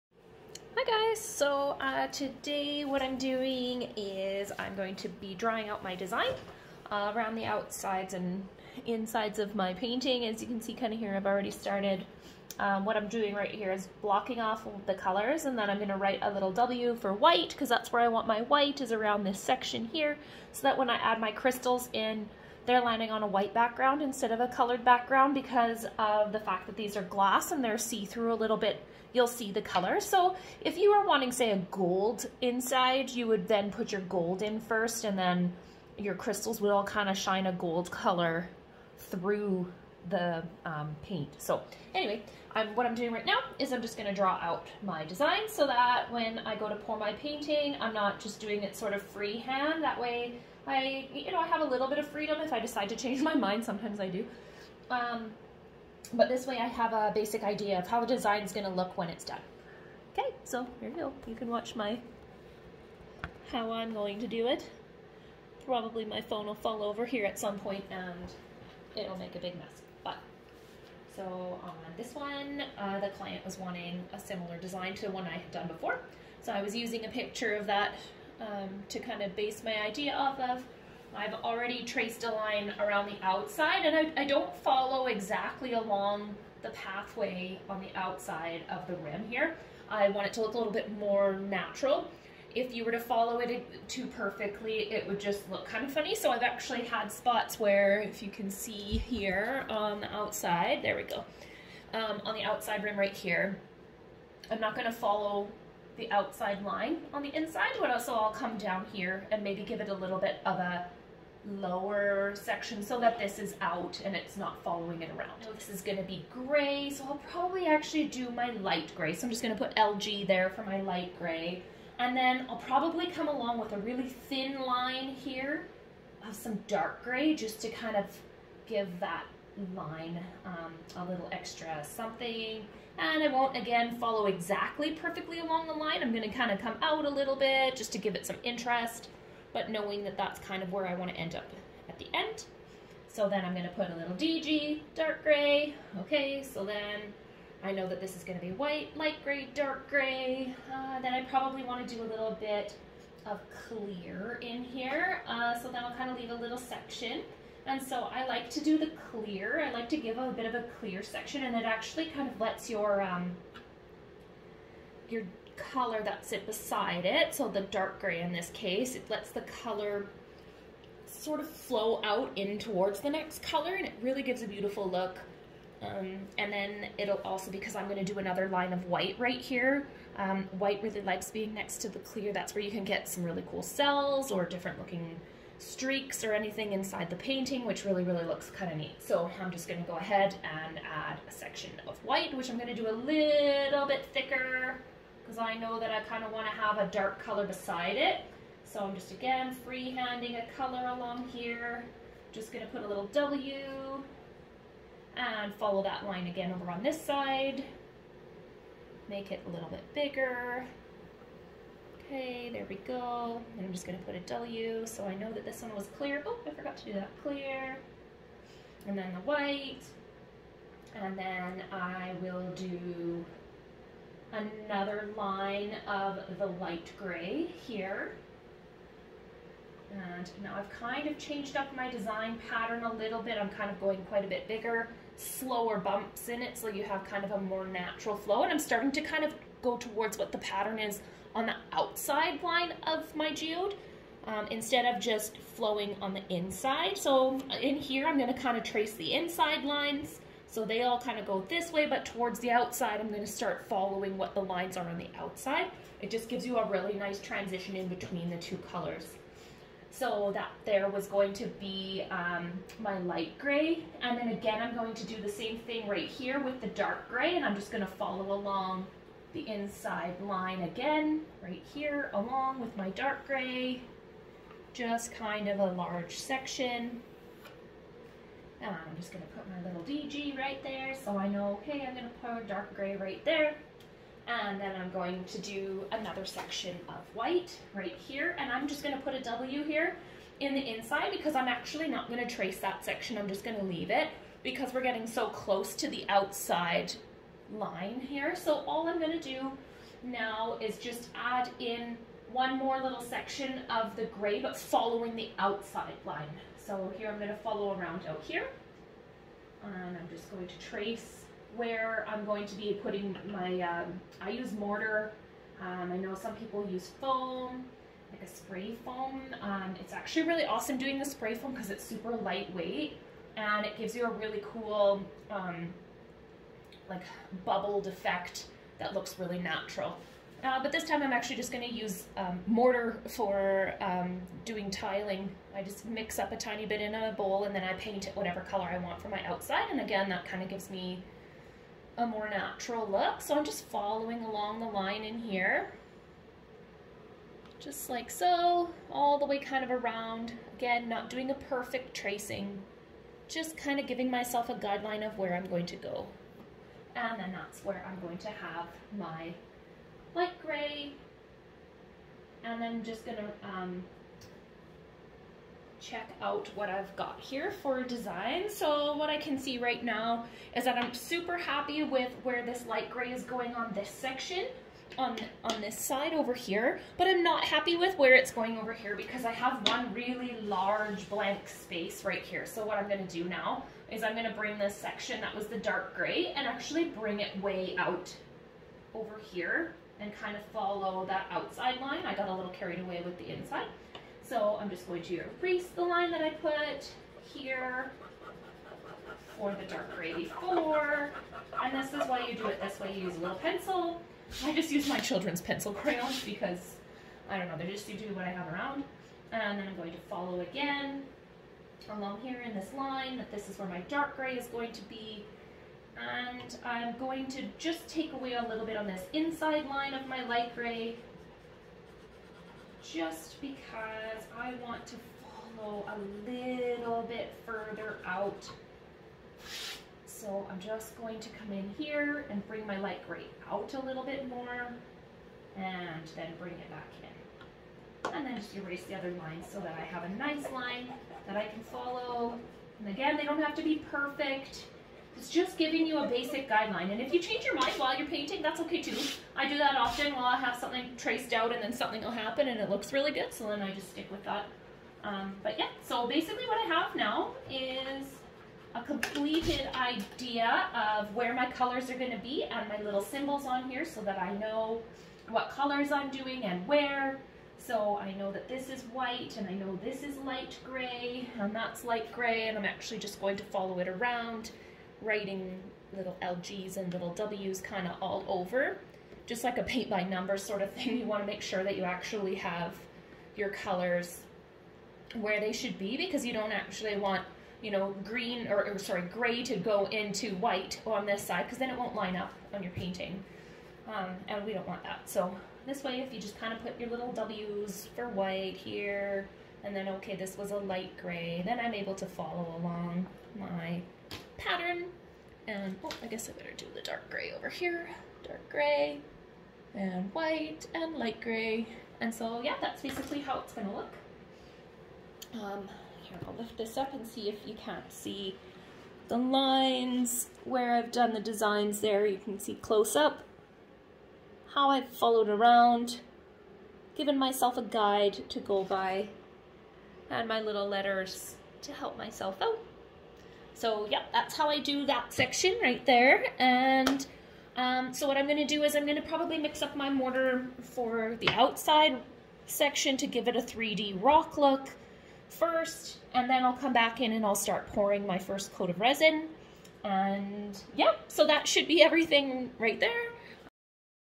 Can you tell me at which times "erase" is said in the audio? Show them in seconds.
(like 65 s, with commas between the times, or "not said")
395 s, 438 s.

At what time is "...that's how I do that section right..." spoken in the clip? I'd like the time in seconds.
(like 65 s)
534 s.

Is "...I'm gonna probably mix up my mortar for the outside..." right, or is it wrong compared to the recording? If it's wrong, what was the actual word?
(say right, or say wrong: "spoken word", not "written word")
right.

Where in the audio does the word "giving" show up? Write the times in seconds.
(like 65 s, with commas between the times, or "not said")
353 s, 445 s.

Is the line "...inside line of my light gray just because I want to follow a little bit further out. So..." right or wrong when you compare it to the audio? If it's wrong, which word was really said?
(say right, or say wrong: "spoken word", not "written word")
right.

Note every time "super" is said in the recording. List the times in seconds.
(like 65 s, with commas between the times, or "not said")
321 s, 370 s.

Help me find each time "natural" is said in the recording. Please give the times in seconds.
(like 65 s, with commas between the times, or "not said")
91 s, 237 s, 329 s, 342 s.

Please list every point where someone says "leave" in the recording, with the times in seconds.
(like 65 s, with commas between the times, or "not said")
156 s, 293 s.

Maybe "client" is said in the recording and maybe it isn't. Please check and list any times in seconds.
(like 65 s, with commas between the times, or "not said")
73 s.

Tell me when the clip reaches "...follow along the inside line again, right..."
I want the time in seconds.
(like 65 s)
267 s.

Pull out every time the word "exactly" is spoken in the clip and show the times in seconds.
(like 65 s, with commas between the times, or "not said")
85 s, 134 s.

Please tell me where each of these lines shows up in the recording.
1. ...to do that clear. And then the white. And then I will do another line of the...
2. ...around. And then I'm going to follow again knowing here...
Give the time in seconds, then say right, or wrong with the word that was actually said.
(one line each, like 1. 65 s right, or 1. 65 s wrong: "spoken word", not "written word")
1. 216 s right
2. 408 s wrong: "along", not "knowing".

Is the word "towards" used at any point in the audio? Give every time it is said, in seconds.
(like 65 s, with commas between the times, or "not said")
172 s, 239 s, 252 s.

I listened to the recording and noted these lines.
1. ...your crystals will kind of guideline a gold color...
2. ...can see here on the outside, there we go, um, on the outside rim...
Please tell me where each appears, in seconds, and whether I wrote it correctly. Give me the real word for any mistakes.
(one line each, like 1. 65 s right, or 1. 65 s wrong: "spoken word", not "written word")
1. 35 s wrong: "shine", not "guideline"
2. 98 s right.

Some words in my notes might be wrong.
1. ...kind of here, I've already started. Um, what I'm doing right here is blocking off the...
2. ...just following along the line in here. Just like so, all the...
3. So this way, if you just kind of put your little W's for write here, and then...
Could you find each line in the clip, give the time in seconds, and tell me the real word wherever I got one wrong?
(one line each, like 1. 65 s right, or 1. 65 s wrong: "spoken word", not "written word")
1. 10 s right
2. 343 s right
3. 495 s wrong: "white", not "write".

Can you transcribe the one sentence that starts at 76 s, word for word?
So I was using a picture of that um, to kind of base my idea off of.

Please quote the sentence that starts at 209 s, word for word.
Make it a little bit bigger.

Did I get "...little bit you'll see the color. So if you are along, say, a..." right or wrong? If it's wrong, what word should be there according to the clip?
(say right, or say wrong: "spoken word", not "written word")
wrong: "wanting", not "along".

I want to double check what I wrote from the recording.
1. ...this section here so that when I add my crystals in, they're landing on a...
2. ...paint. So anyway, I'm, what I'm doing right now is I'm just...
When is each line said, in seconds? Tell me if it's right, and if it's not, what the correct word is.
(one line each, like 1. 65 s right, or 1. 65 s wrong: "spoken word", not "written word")
1. 19 s right
2. 41 s right.